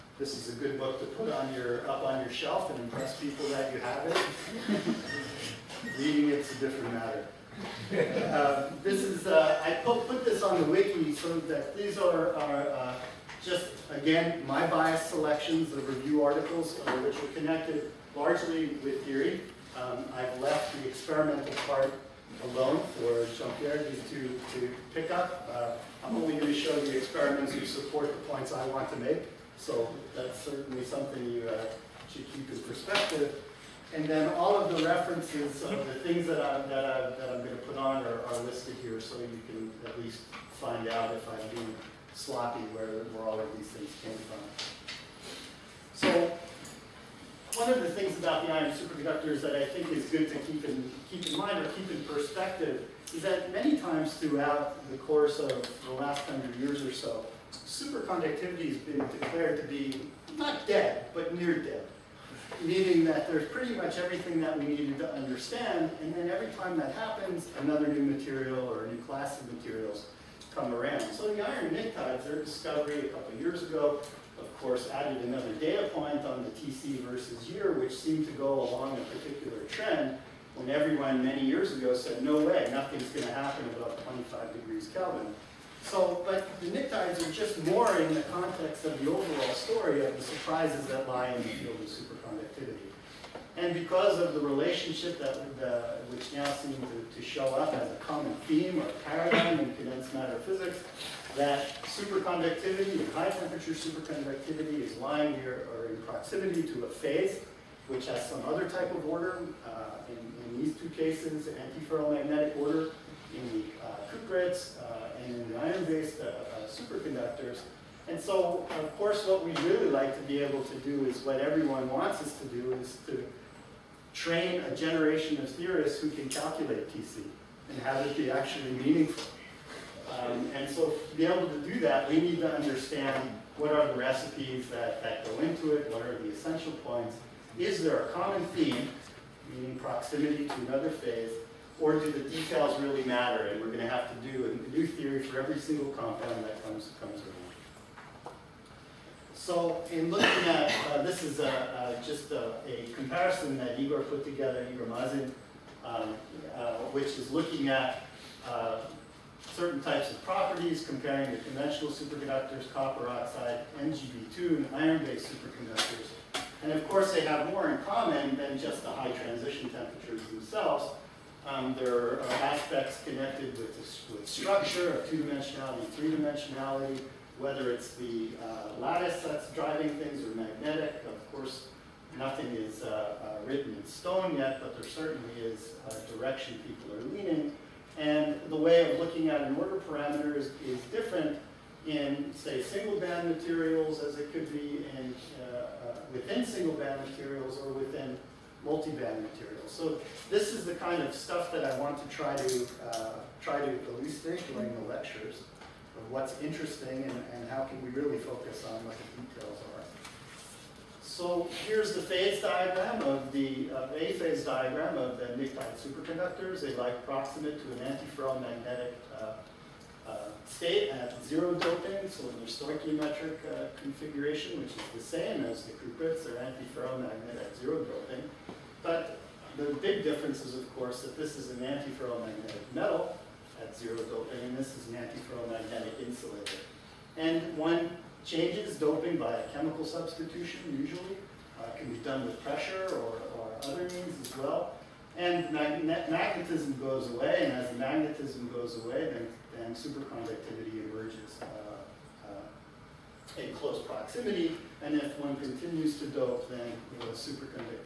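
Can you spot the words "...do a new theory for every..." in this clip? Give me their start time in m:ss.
2:24.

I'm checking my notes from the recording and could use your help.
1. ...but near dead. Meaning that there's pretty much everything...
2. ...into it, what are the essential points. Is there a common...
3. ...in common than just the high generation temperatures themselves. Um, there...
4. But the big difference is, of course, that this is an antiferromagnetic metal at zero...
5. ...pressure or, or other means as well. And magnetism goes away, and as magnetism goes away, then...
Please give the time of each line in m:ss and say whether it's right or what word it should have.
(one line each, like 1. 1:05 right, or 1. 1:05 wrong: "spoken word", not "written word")
1. 1:01 right
2. 2:15 right
3. 2:47 wrong: "transition", not "generation"
4. 3:48 right
5. 4:02 right.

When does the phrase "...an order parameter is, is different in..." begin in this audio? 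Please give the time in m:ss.
3:09.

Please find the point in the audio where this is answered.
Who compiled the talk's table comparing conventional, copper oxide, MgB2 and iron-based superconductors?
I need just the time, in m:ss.
2:34.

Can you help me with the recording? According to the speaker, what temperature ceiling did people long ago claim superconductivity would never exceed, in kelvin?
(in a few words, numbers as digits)
25.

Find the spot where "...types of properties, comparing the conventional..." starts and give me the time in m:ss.
2:39.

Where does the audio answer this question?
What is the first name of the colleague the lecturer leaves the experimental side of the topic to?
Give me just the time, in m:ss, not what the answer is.
0:23.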